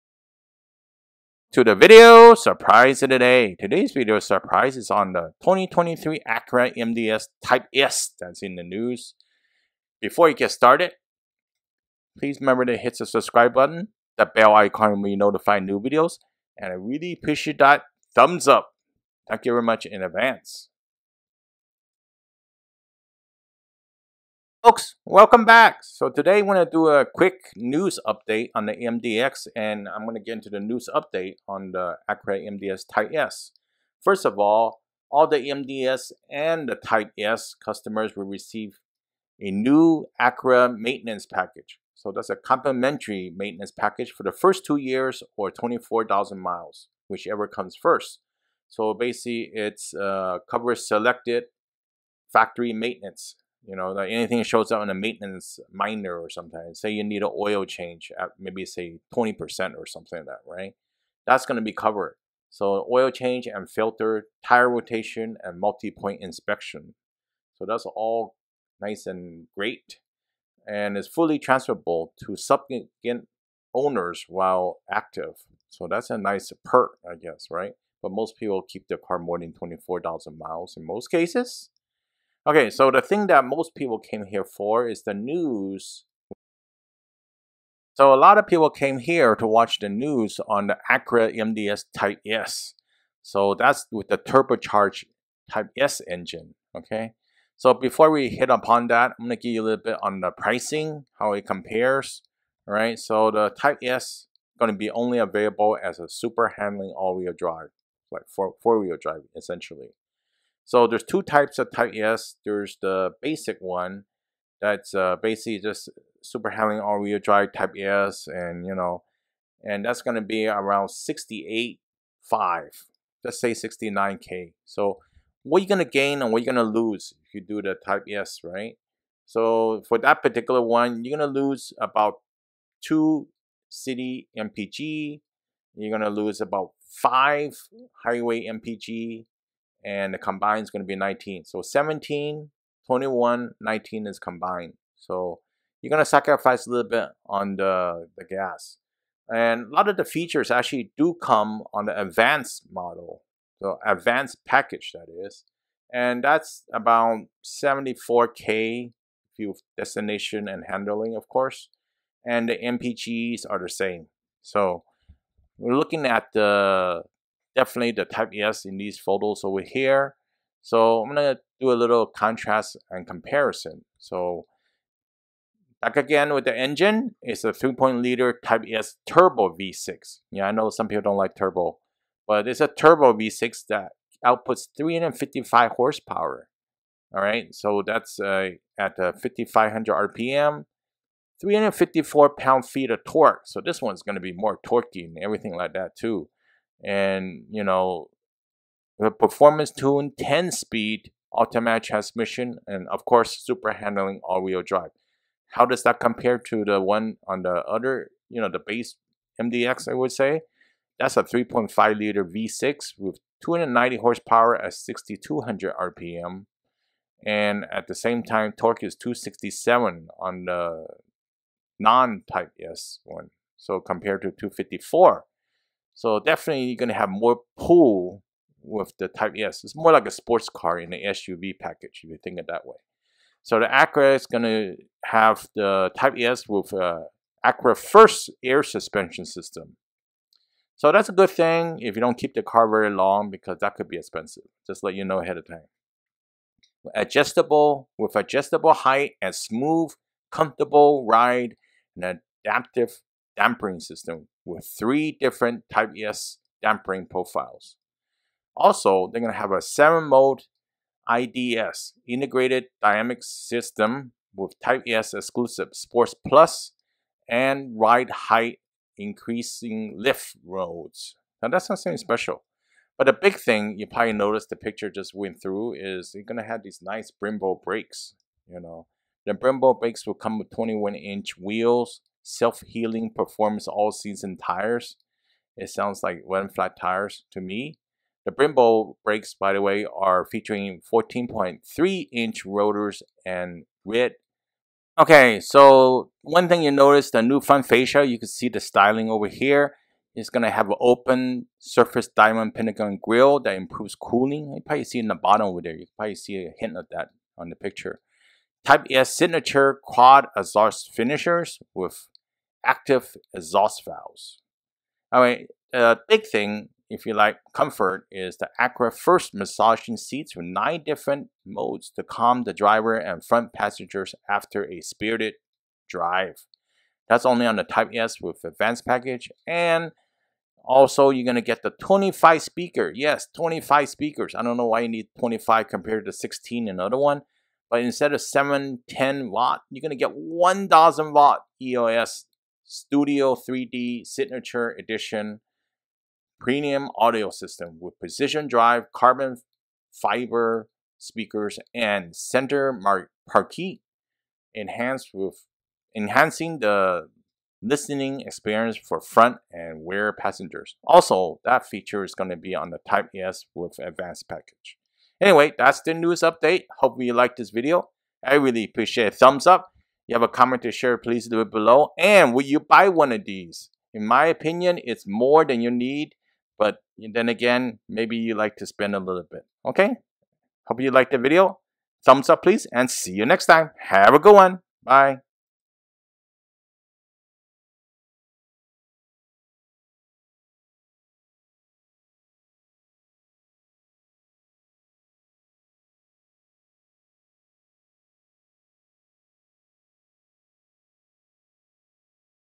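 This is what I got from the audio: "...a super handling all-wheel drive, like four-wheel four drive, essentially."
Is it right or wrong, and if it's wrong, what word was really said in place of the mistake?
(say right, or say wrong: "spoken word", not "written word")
right.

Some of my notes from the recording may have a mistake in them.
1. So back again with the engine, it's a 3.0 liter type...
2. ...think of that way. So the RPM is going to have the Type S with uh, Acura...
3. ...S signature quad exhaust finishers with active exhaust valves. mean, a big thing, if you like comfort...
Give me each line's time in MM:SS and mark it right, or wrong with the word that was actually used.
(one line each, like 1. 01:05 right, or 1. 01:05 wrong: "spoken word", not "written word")
1. 02:53 right
2. 03:52 wrong: "Acura", not "RPM"
3. 05:08 right.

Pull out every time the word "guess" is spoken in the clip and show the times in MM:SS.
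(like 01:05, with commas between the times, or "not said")
01:17.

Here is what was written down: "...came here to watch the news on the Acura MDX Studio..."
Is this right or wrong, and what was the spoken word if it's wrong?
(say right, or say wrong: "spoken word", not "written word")
wrong: "Type", not "Studio".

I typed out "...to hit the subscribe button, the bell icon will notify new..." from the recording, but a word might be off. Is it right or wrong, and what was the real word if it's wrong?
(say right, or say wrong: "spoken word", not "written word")
right.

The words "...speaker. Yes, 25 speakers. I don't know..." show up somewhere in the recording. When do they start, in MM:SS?
05:32.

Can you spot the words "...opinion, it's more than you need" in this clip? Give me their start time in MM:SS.
06:14.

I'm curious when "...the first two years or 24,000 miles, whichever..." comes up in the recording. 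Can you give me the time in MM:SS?
00:44.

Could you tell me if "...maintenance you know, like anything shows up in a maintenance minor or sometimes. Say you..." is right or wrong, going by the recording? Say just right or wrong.
right.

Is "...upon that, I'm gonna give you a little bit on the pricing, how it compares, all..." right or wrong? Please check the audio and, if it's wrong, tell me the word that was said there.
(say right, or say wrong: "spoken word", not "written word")
right.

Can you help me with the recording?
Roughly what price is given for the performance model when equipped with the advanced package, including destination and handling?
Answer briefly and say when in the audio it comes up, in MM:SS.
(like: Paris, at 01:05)
74K, at 02:37.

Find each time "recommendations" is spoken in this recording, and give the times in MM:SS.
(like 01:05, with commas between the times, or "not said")
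not said.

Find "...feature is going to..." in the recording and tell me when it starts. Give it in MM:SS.
06:01.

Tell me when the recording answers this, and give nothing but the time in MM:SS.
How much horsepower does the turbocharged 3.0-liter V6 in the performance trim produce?
03:04.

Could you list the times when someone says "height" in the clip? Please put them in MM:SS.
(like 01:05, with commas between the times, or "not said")
04:08, 04:28.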